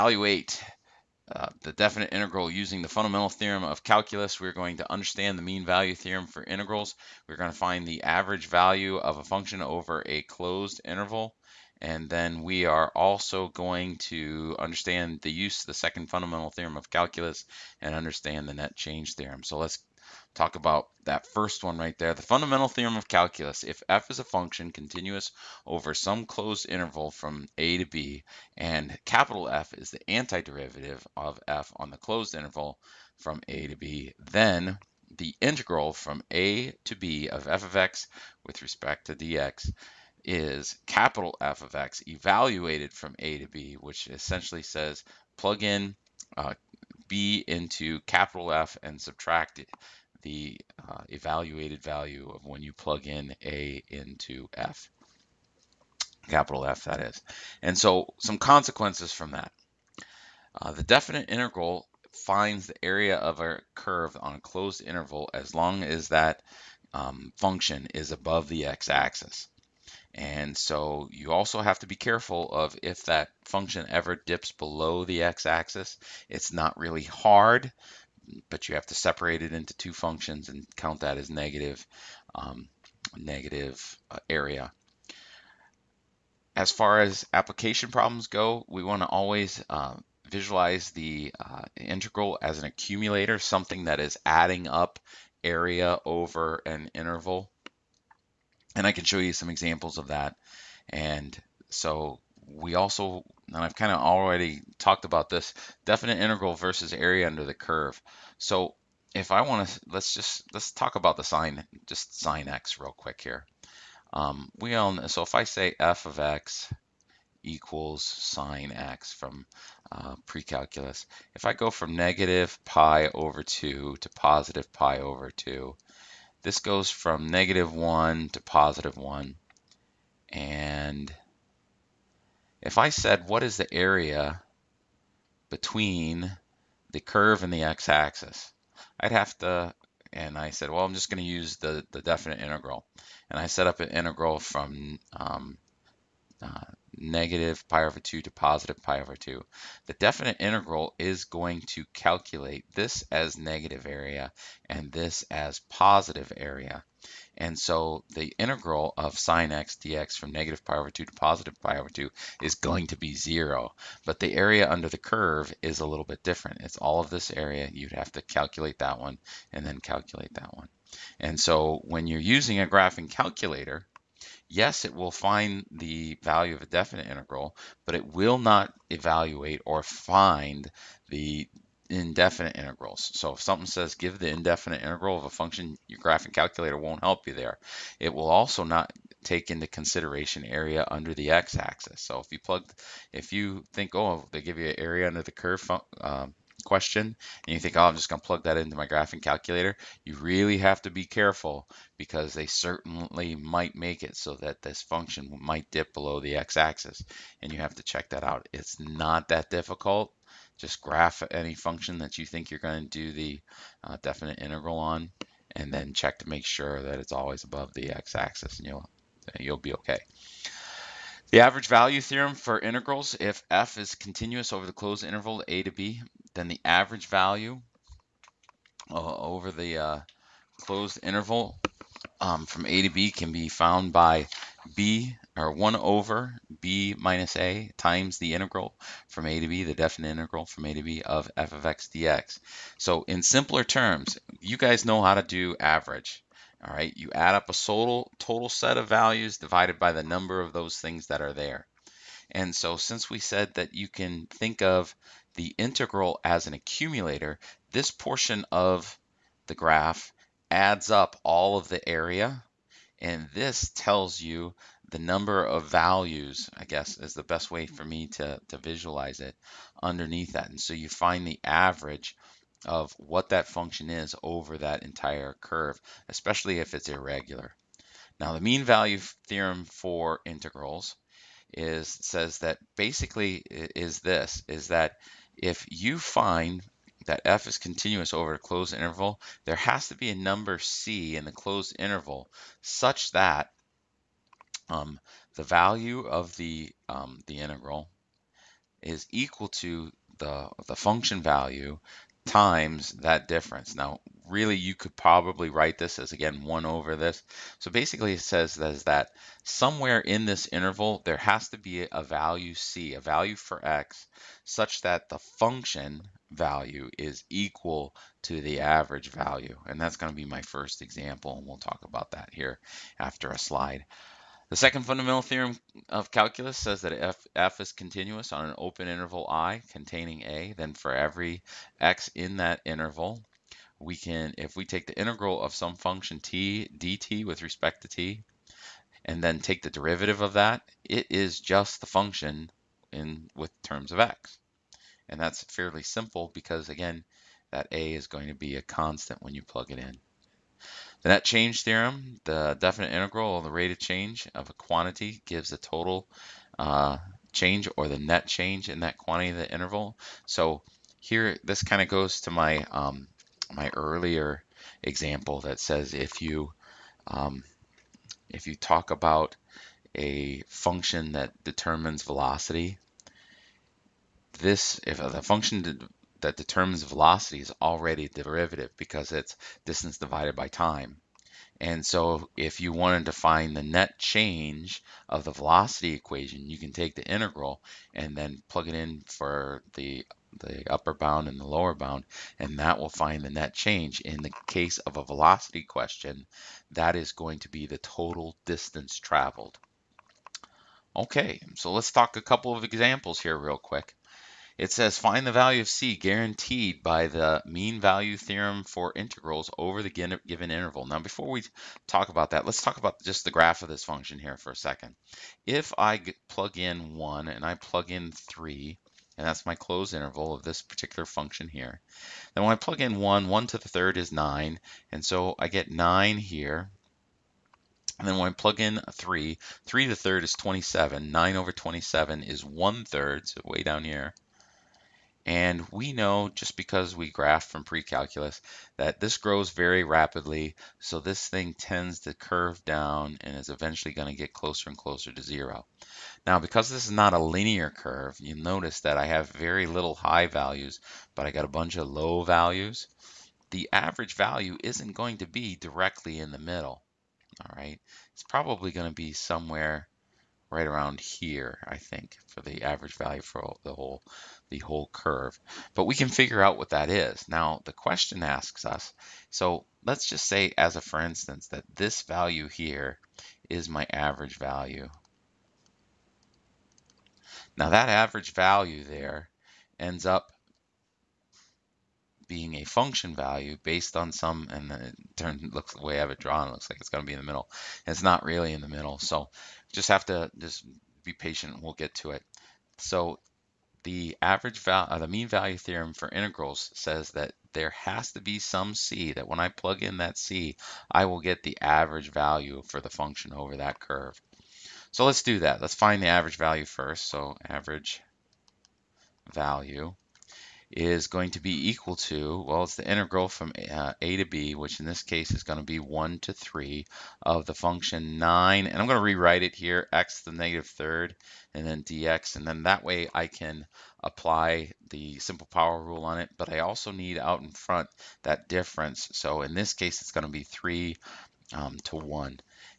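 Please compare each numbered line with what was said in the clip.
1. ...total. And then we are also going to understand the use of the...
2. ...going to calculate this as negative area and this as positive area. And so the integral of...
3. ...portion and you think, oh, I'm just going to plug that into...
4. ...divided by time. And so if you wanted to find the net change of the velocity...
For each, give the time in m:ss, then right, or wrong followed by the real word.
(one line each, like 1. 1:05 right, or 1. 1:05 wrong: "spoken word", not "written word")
1. 0:10 wrong: "interval", not "total"
2. 2:31 right
3. 3:16 wrong: "question", not "portion"
4. 6:19 right.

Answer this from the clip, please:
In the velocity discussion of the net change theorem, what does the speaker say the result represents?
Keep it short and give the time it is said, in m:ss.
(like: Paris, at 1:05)
total distance traveled, at 6:37.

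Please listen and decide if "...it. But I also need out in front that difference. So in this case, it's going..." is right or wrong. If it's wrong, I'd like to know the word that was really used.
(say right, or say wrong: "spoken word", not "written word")
right.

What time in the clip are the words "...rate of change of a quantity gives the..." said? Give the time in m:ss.
5:53.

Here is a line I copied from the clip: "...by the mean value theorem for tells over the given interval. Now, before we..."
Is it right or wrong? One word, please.
wrong.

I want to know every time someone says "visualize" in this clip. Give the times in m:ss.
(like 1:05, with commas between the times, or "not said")
1:30, 4:28.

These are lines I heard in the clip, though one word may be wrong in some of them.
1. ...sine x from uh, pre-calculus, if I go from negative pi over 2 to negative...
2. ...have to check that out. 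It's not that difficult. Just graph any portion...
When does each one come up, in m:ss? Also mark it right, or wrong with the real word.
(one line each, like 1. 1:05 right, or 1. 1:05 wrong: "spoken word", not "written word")
1. 1:58 wrong: "positive", not "negative"
2. 3:27 wrong: "function", not "portion".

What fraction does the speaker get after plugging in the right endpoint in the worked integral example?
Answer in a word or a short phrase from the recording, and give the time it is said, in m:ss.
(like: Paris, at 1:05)
1/3, at 7:12.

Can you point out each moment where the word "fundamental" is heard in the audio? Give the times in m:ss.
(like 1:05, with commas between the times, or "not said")
0:02, 0:16, 0:22, 5:24.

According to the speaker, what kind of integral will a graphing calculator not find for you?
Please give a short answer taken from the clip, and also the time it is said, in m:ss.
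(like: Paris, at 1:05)
indefinite integrals, at 3:01.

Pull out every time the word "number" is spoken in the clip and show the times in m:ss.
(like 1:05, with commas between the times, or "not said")
4:10, 4:24, 4:50.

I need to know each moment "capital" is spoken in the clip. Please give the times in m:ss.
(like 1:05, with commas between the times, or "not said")
0:29, 0:40, 0:48, 0:56.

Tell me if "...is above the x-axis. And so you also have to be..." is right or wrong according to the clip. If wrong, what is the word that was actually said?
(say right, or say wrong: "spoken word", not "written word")
right.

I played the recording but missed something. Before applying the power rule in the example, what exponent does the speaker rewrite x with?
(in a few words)
negative third.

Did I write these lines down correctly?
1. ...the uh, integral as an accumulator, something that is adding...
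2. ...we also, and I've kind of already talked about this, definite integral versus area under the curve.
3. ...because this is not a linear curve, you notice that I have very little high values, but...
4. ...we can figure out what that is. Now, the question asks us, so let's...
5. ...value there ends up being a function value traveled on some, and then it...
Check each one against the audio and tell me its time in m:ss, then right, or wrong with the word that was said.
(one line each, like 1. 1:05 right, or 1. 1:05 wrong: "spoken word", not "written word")
1. 1:30 right
2. 1:42 right
3. 7:26 right
4. 7:45 right
5. 7:58 wrong: "based", not "traveled".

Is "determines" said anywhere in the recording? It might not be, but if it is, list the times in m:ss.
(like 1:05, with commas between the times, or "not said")
6:11, 6:16.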